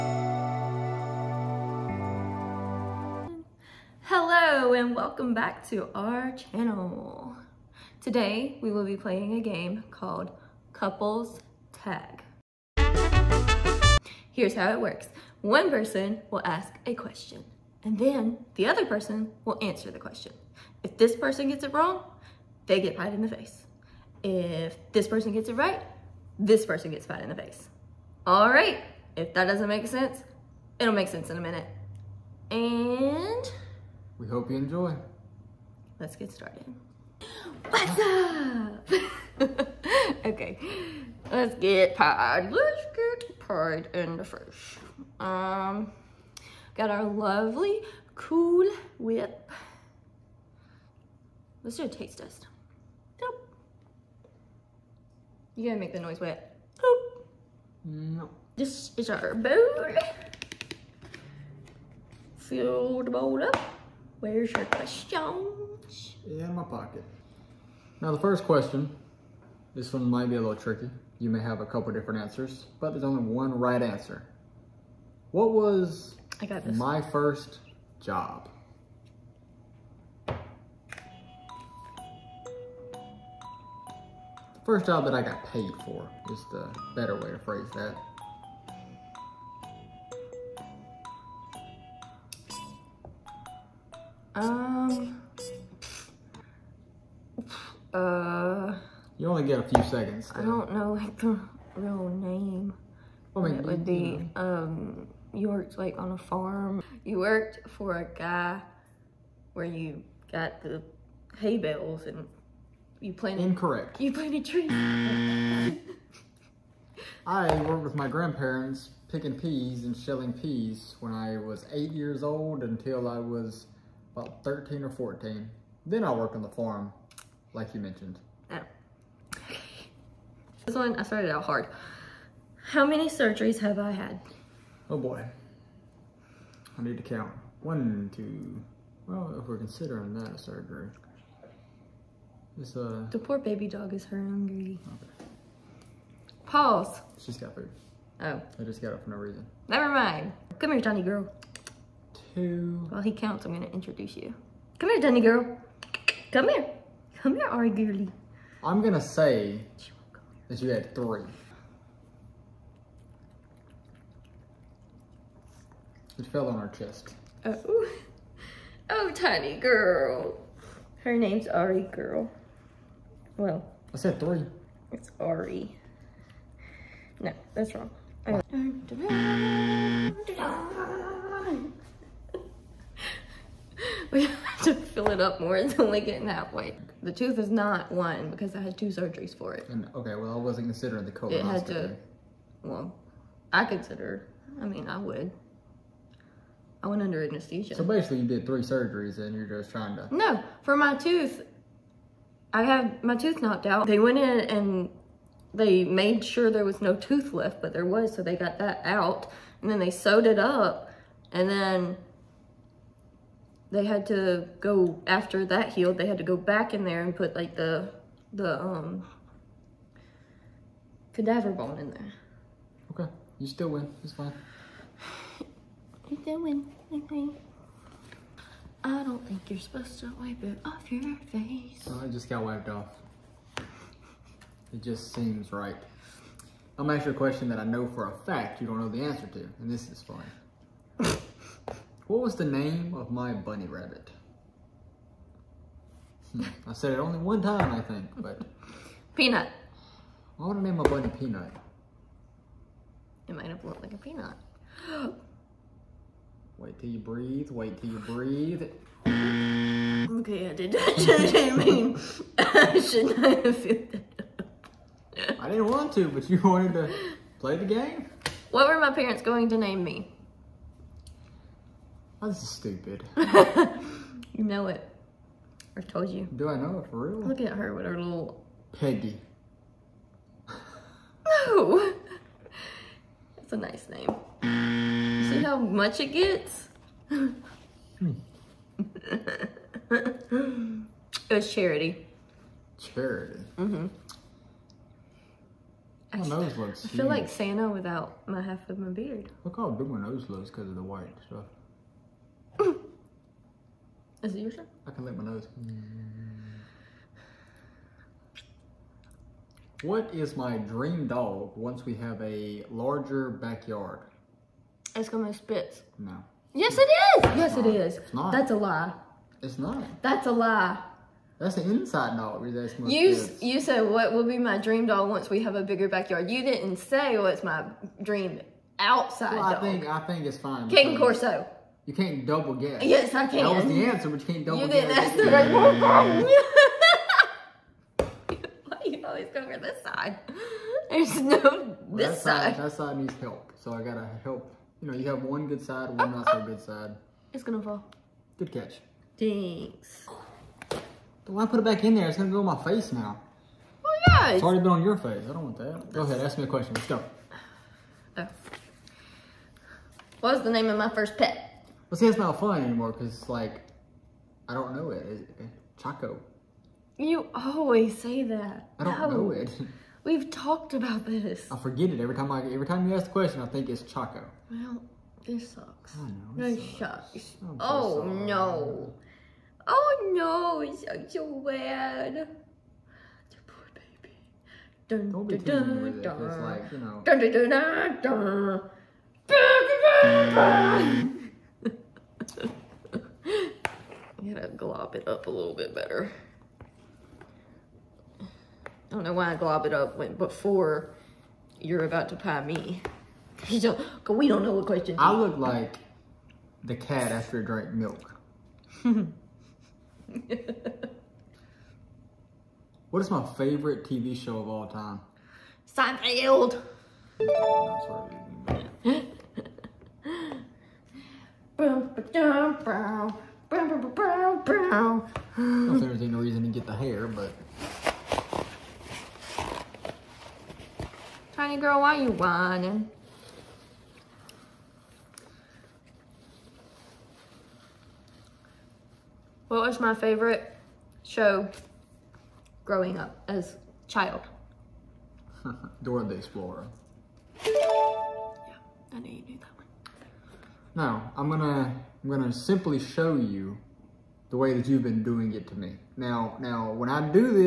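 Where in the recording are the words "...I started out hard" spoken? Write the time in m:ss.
2:10.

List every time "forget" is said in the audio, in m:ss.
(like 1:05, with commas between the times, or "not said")
6:11.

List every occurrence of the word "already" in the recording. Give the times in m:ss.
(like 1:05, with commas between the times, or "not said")
5:54.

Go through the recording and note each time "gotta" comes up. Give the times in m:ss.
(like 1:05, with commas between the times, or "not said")
0:55, 5:43, 6:34.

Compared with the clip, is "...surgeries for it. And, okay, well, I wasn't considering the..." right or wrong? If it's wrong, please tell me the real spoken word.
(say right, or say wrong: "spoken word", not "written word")
right.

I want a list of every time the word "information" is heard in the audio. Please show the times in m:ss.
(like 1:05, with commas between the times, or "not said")
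not said.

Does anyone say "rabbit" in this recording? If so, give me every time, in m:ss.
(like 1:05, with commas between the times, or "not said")
4:03.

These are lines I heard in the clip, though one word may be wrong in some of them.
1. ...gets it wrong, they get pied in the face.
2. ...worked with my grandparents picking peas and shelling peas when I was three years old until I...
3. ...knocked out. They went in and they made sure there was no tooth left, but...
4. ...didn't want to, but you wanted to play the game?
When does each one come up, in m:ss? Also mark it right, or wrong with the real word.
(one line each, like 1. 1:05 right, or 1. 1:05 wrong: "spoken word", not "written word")
1. 0:21 right
2. 1:57 wrong: "eight", not "three"
3. 3:23 right
4. 4:25 right.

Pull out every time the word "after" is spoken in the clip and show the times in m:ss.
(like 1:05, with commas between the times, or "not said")
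3:35, 6:47.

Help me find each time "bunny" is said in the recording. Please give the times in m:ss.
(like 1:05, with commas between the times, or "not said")
4:03, 4:10.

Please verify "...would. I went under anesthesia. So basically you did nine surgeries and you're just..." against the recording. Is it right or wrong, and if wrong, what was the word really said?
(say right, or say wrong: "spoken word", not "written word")
wrong: "three", not "nine".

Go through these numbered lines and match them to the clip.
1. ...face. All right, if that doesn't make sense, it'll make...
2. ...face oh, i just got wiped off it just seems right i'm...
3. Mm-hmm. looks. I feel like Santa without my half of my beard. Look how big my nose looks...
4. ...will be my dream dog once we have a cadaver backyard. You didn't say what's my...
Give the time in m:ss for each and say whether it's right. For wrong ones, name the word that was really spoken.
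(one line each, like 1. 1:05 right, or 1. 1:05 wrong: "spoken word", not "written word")
1. 0:27 right
2. 3:51 right
3. 4:53 right
4. 5:24 wrong: "bigger", not "cadaver".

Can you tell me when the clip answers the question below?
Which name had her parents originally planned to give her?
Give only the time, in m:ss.
4:49.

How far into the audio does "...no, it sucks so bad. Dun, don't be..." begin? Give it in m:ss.
6:20.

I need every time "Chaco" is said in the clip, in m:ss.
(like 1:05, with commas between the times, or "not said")
6:05, 6:13.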